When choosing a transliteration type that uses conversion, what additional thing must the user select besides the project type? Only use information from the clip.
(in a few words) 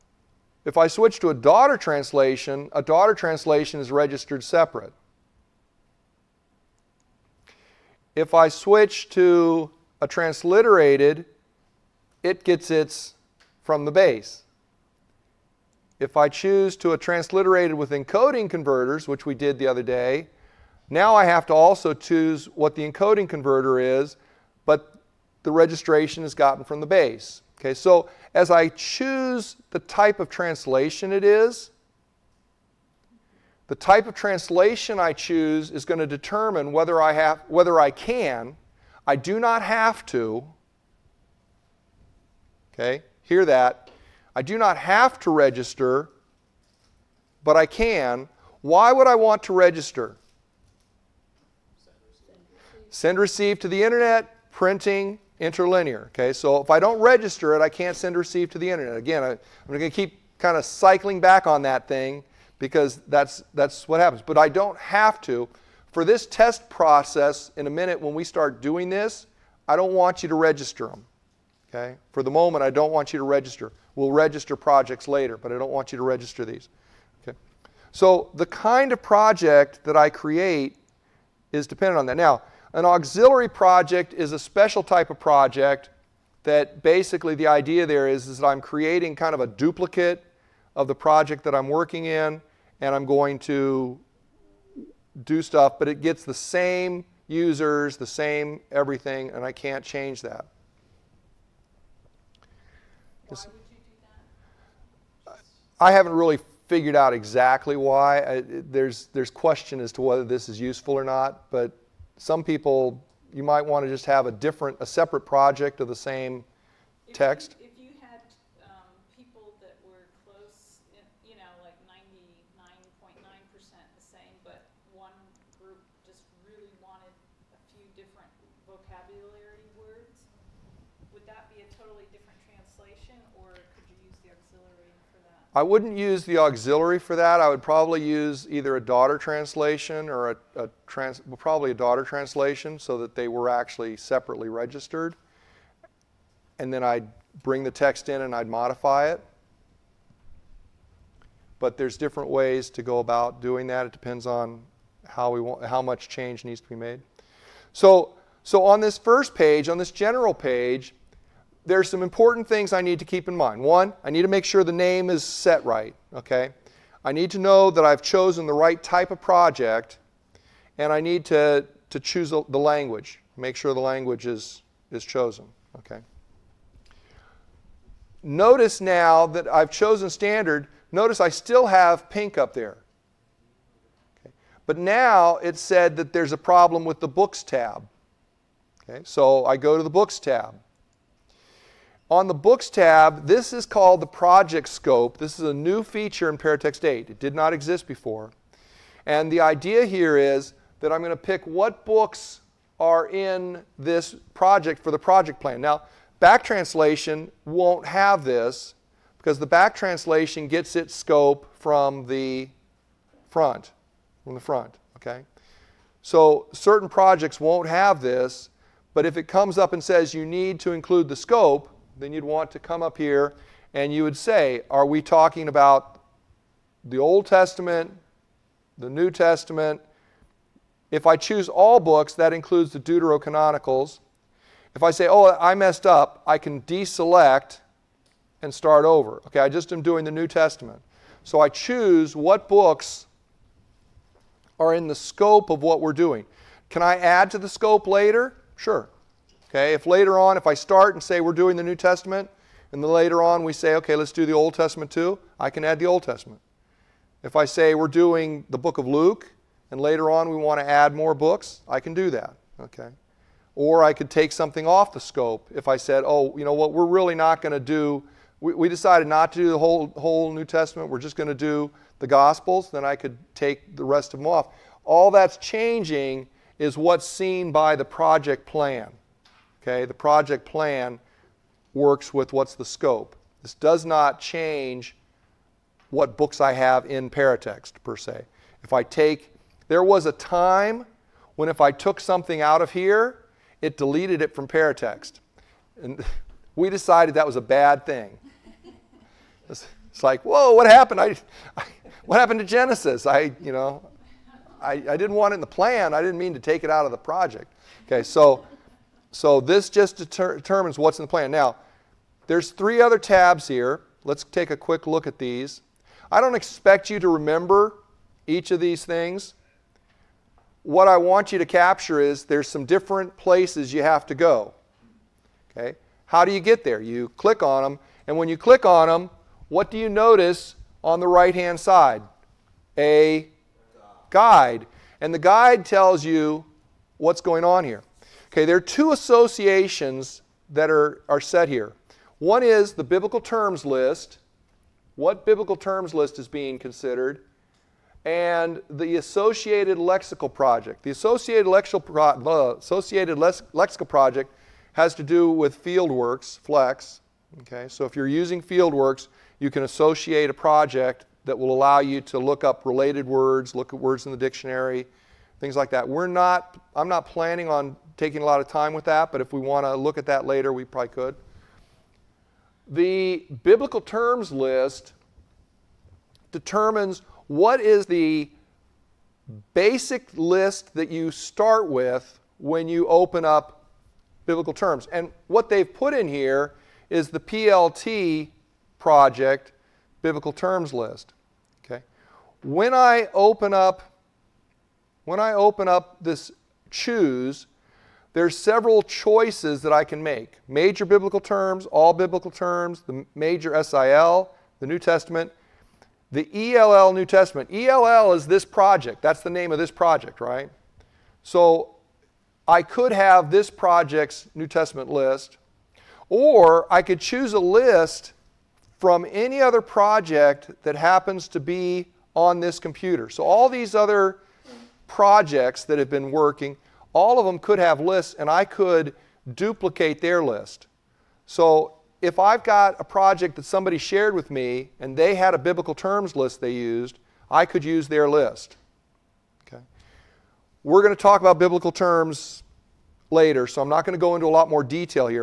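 Encoding converter.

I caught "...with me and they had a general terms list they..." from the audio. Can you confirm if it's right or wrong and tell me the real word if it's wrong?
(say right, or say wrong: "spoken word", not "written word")
wrong: "biblical", not "general".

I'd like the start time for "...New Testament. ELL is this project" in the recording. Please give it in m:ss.
6:46.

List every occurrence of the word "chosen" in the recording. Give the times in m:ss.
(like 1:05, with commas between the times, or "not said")
2:48, 2:55, 2:59.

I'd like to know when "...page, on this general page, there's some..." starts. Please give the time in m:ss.
2:39.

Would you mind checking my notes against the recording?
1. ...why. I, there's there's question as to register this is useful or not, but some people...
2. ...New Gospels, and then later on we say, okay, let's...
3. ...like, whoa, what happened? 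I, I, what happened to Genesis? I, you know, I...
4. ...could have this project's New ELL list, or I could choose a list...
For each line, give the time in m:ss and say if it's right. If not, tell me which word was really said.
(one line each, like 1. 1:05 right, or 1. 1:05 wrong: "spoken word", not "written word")
1. 1:47 wrong: "whether", not "register"
2. 4:11 wrong: "Testament", not "Gospels"
3. 5:00 right
4. 6:52 wrong: "Testament", not "ELL".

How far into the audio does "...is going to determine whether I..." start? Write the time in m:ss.
0:35.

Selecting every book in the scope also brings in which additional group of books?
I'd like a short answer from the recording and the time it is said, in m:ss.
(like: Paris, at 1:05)
Deuterocanonicals, at 3:52.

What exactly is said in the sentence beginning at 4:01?
So I choose what books are in the scope of what we're doing.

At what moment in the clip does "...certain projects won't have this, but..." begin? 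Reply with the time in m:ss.
3:36.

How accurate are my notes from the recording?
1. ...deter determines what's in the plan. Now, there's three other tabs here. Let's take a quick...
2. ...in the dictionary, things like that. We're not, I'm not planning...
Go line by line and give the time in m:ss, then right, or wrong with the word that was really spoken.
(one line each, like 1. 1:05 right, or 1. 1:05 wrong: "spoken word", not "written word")
1. 5:09 right
2. 6:04 right.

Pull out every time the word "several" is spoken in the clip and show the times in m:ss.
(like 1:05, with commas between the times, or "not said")
6:38.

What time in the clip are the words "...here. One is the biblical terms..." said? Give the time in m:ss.
5:41.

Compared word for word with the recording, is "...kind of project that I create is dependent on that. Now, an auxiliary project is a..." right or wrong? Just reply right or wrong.
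right.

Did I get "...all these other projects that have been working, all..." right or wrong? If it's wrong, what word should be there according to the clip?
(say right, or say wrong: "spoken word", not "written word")
right.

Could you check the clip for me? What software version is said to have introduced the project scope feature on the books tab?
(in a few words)
Paratext 8.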